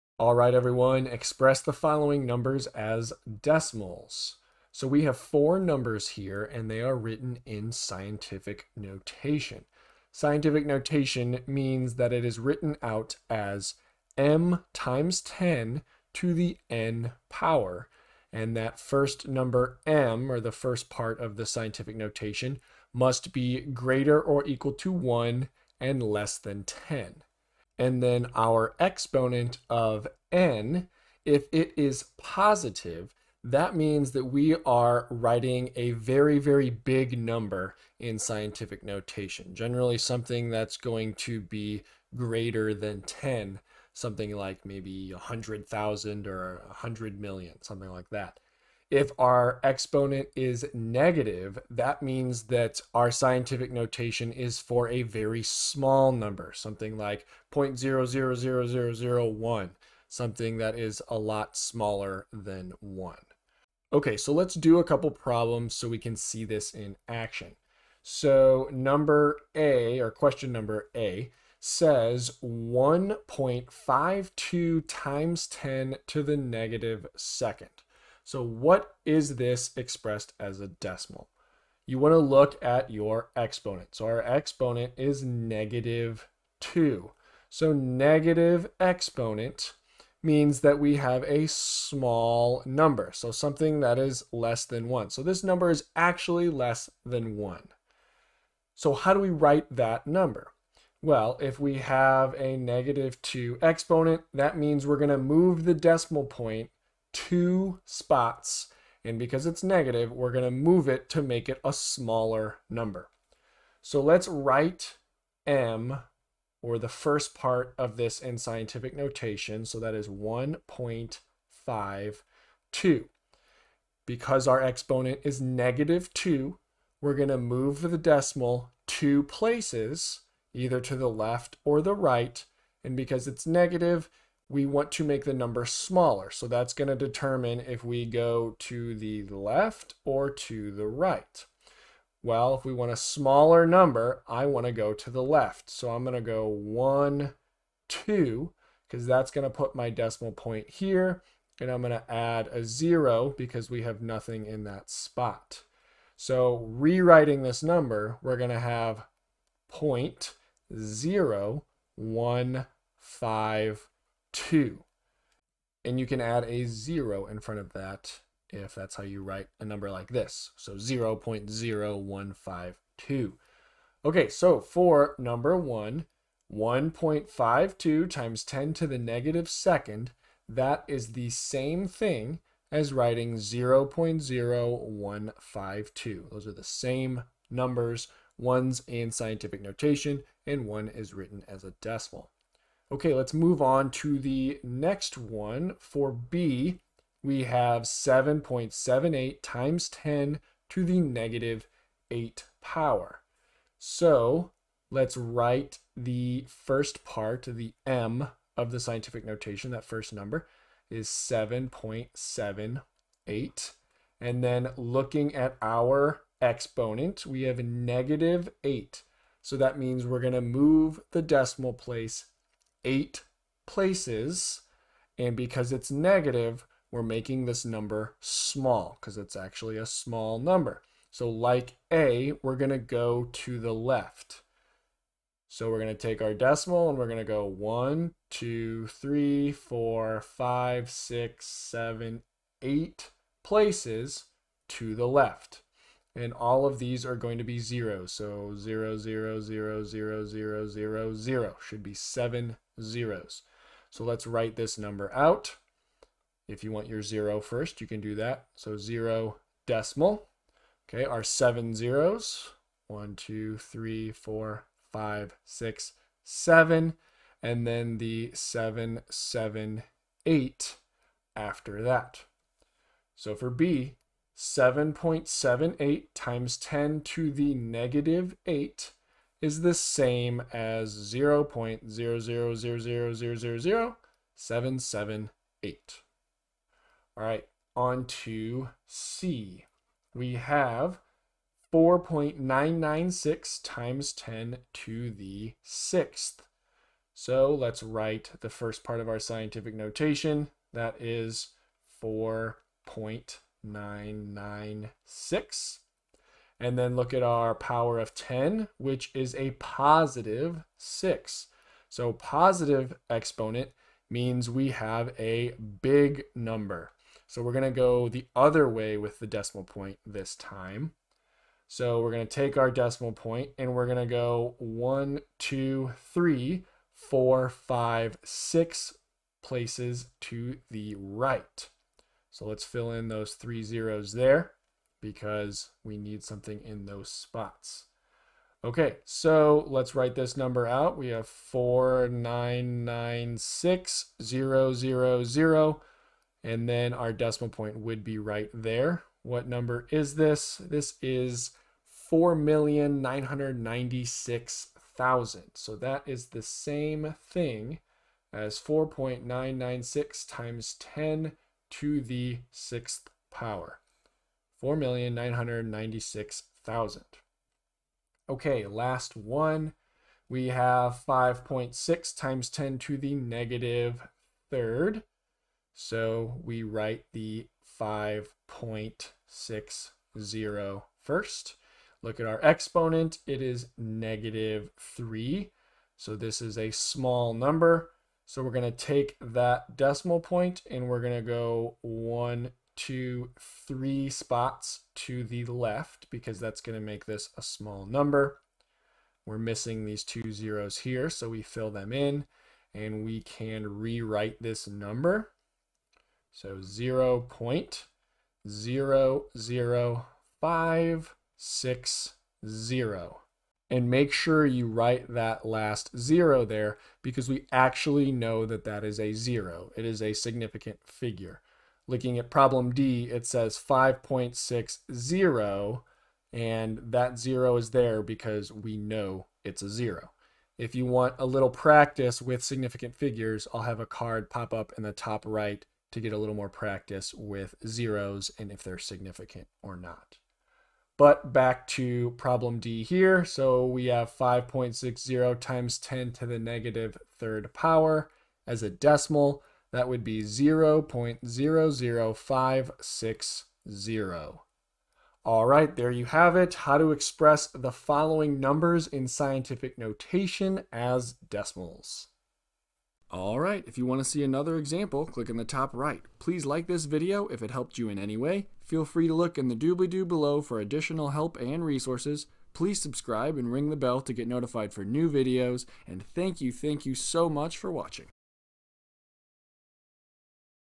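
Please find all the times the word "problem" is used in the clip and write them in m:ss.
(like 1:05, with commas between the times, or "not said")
1:05, 7:02, 7:22.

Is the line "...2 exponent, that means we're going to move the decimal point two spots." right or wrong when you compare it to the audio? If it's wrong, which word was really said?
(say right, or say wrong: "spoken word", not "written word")
right.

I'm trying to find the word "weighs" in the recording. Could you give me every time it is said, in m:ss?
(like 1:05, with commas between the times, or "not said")
not said.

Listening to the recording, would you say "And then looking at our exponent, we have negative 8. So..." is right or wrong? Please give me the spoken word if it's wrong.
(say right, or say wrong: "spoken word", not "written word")
right.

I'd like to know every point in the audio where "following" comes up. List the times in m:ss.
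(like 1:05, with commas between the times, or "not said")
0:01, 7:37.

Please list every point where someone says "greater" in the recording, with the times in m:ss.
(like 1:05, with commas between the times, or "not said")
0:23, 0:42.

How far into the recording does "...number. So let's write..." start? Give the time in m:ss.
1:52.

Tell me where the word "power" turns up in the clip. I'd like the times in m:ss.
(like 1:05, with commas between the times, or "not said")
0:17, 3:22, 5:07, 6:03, 7:27.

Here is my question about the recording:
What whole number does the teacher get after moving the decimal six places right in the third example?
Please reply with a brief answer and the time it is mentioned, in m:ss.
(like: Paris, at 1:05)
4,996,000, at 5:50.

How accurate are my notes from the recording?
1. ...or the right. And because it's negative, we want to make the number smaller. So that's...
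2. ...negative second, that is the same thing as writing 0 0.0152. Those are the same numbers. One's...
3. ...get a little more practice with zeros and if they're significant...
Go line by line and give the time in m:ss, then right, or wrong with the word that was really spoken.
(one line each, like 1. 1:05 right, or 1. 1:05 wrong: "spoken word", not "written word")
1. 2:11 right
2. 2:58 right
3. 7:16 right.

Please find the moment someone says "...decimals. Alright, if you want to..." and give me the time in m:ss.
7:41.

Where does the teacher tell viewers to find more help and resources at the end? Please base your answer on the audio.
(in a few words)
doobly-doo below.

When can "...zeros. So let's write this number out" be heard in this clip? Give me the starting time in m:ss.
4:12.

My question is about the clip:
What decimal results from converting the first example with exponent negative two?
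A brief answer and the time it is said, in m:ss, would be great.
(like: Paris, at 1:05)
0.0152, at 2:39.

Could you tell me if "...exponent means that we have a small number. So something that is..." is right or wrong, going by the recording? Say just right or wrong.
right.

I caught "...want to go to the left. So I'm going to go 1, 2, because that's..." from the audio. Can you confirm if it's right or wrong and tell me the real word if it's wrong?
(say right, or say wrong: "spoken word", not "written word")
right.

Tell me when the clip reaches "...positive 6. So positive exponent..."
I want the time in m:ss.
5:09.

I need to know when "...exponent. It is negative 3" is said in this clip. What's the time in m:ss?
6:22.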